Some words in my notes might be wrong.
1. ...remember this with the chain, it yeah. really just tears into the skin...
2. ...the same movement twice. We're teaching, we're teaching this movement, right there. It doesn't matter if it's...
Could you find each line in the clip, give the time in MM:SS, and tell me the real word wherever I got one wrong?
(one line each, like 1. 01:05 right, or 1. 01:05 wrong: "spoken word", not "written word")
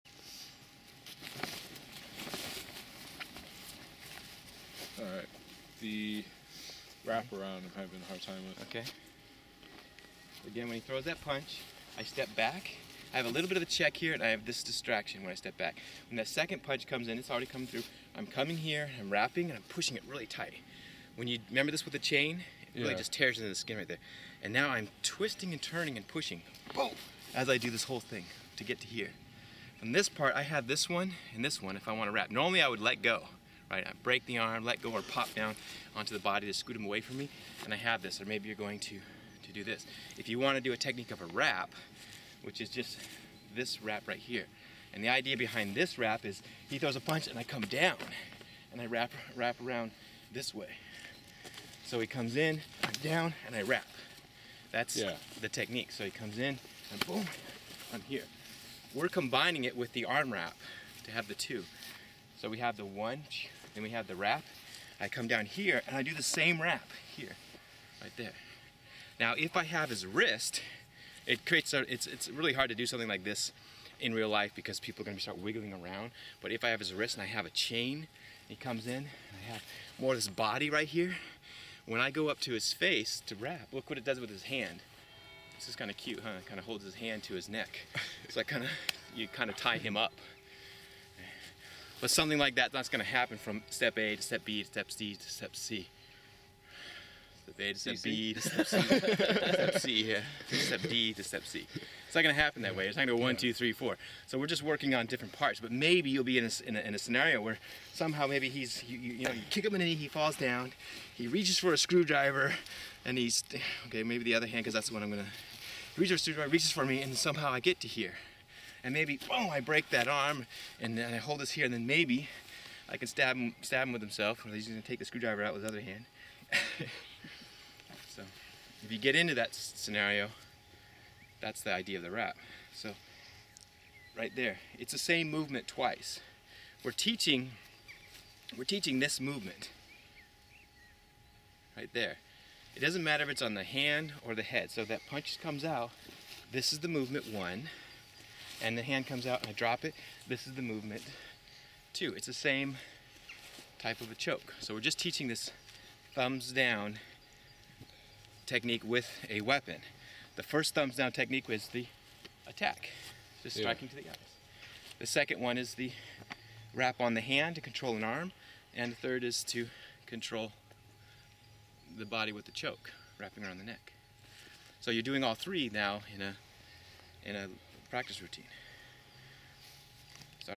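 1. 00:21 right
2. 02:14 right.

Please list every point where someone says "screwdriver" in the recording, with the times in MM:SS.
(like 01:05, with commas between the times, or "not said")
01:51, 01:56, 02:05.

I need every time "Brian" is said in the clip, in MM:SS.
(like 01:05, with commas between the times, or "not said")
not said.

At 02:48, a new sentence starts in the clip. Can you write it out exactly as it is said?
And the third is to control the body with the choke, wrapping around the neck.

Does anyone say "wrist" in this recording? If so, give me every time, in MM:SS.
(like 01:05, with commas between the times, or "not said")
01:10, 01:16.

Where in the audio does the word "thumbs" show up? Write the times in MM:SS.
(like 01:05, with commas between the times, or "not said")
02:36, 02:40.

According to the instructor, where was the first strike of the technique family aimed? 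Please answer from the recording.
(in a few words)
the eyes.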